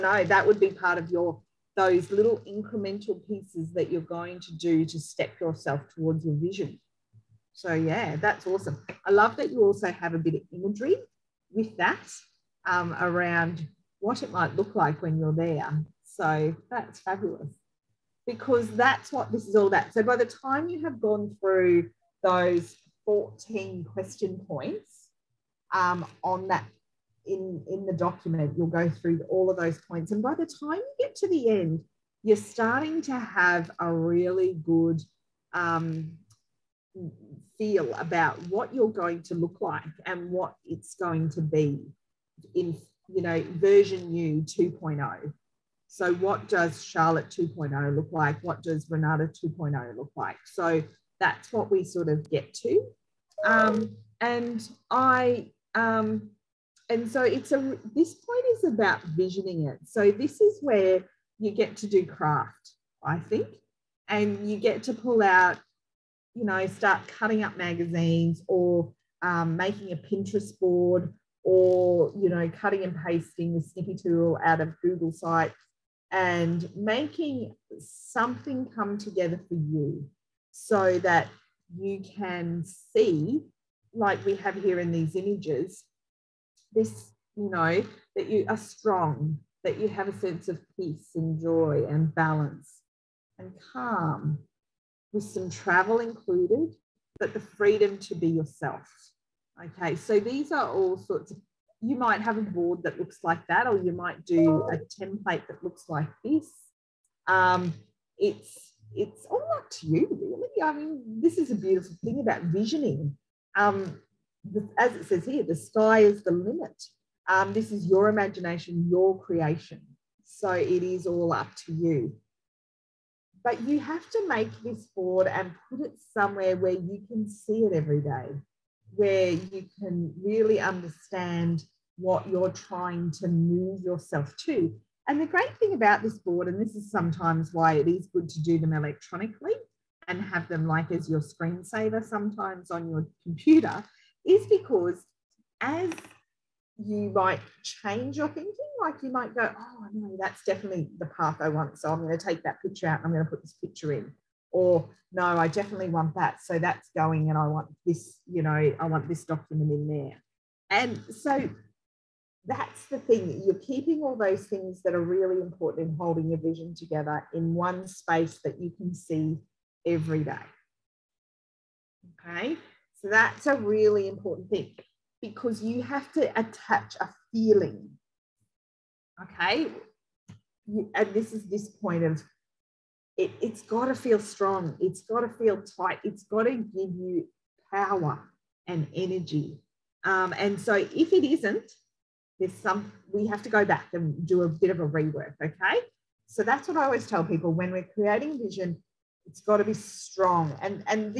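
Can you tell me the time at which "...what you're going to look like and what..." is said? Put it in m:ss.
0:38.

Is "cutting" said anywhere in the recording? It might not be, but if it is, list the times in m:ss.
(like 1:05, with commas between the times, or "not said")
1:07, 1:12.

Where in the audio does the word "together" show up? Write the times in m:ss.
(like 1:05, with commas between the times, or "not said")
1:18, 2:46.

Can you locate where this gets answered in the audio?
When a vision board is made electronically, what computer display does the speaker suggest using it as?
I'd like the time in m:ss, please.
2:21.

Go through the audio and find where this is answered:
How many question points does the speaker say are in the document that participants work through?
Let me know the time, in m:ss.
0:23.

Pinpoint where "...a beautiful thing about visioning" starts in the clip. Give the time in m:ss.
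1:51.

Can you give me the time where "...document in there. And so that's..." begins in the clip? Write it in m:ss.
2:39.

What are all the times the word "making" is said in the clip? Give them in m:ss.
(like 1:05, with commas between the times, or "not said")
1:09, 1:16.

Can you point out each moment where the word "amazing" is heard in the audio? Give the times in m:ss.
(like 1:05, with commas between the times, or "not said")
not said.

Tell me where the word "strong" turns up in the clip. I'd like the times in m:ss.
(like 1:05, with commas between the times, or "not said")
1:28, 3:04, 3:19.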